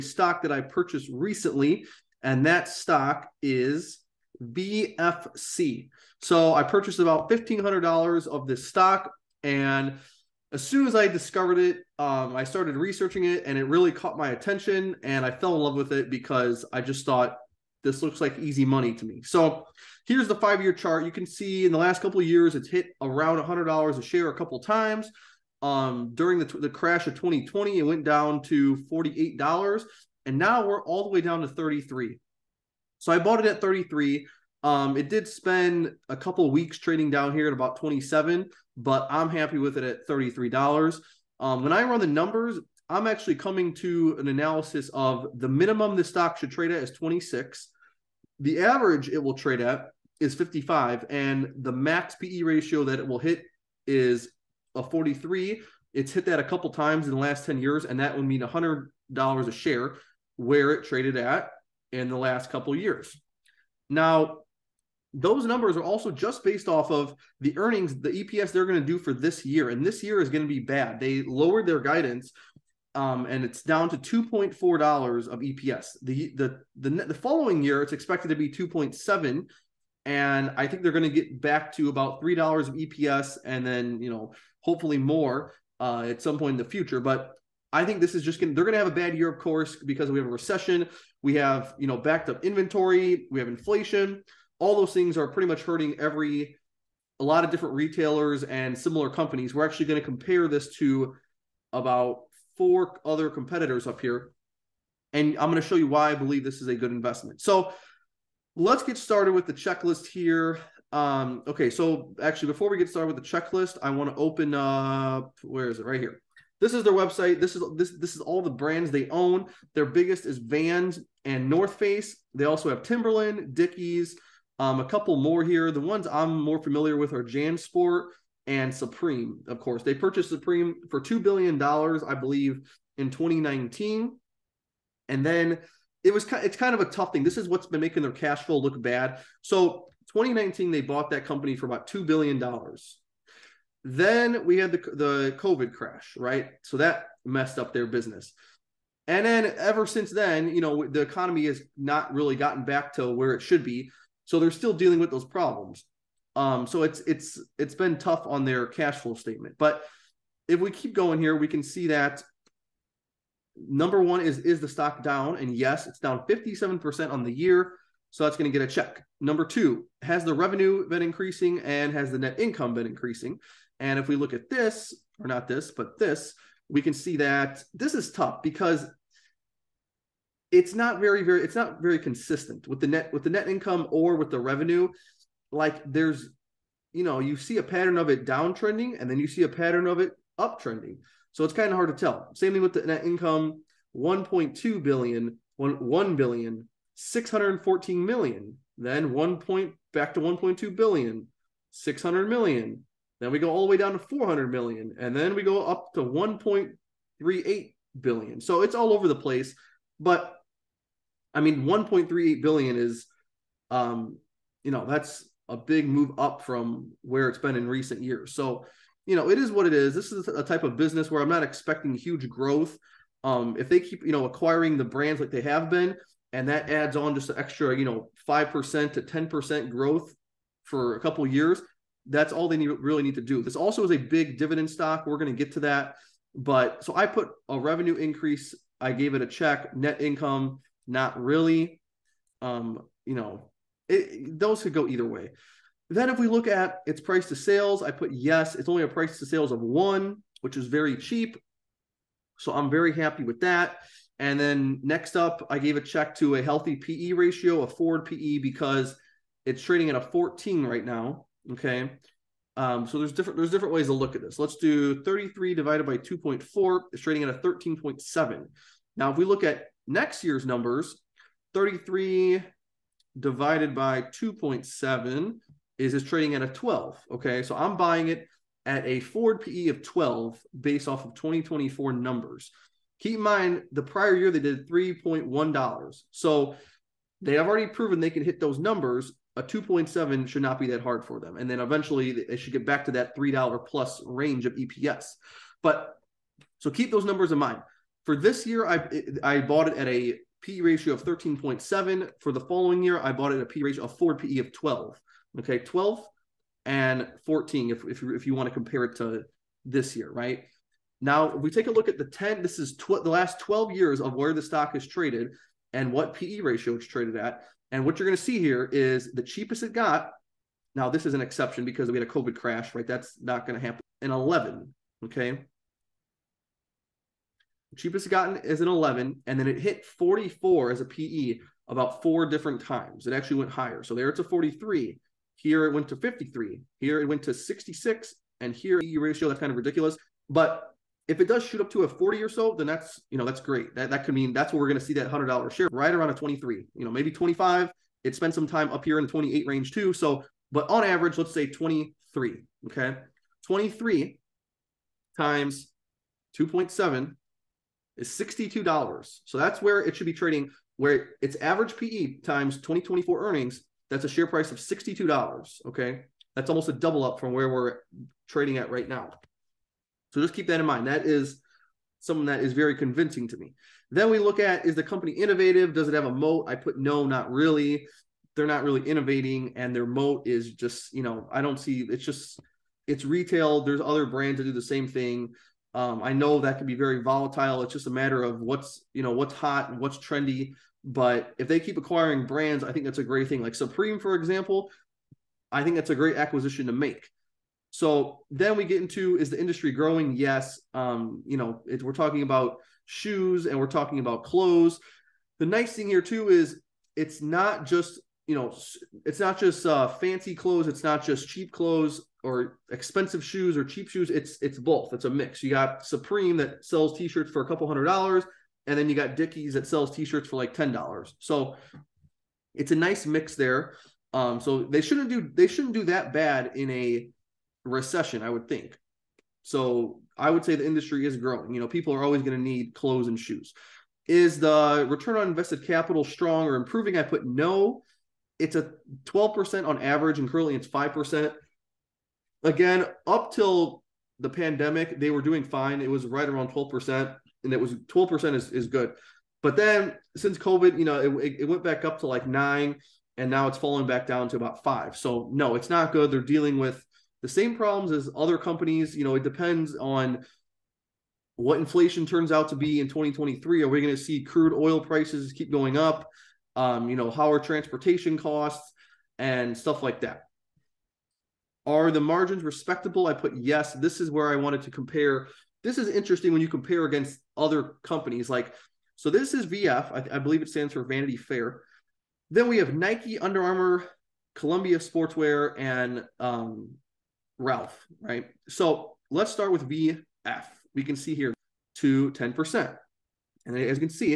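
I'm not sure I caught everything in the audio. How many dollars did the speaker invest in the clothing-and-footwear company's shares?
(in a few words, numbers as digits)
$1,500.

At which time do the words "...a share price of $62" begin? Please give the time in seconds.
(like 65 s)
364 s.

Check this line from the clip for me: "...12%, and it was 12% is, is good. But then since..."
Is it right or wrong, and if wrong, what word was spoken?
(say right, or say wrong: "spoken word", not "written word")
right.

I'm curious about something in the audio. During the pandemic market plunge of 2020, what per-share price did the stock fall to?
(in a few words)
$48.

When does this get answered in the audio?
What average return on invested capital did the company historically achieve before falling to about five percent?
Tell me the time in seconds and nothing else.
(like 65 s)
439 s.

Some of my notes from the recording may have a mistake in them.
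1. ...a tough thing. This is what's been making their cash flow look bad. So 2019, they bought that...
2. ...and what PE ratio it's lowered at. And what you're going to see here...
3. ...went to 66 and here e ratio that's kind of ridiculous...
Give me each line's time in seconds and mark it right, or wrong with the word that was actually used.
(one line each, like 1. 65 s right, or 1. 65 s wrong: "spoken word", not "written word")
1. 136 s right
2. 315 s wrong: "traded", not "lowered"
3. 337 s right.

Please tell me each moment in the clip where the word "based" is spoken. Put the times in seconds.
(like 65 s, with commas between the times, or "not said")
66 s, 280 s.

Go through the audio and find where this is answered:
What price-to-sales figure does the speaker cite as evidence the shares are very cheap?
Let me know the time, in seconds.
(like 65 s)
248 s.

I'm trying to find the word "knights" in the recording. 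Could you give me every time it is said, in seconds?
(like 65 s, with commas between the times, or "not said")
not said.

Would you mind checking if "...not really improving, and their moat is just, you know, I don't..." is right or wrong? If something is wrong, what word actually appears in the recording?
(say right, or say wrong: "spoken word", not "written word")
wrong: "innovating", not "improving".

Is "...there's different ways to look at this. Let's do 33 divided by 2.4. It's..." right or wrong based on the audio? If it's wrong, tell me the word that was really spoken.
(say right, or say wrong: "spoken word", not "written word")
right.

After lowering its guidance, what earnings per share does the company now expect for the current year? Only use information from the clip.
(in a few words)
$2.40.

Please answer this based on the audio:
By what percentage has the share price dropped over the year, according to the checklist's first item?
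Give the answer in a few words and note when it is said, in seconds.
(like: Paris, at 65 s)
57%, at 166 s.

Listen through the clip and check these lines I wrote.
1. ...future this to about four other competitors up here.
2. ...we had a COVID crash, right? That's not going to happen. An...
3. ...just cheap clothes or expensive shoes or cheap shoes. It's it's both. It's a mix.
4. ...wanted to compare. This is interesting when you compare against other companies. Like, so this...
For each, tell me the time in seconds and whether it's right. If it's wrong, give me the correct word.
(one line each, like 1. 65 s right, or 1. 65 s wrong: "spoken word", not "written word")
1. 100 s wrong: "compare", not "future"
2. 321 s right
3. 411 s right
4. 474 s right.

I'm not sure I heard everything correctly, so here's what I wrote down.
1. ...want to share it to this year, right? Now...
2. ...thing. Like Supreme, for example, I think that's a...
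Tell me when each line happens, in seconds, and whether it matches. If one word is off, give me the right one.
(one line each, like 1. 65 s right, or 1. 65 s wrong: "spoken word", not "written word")
1. 308 s wrong: "compare", not "share"
2. 393 s right.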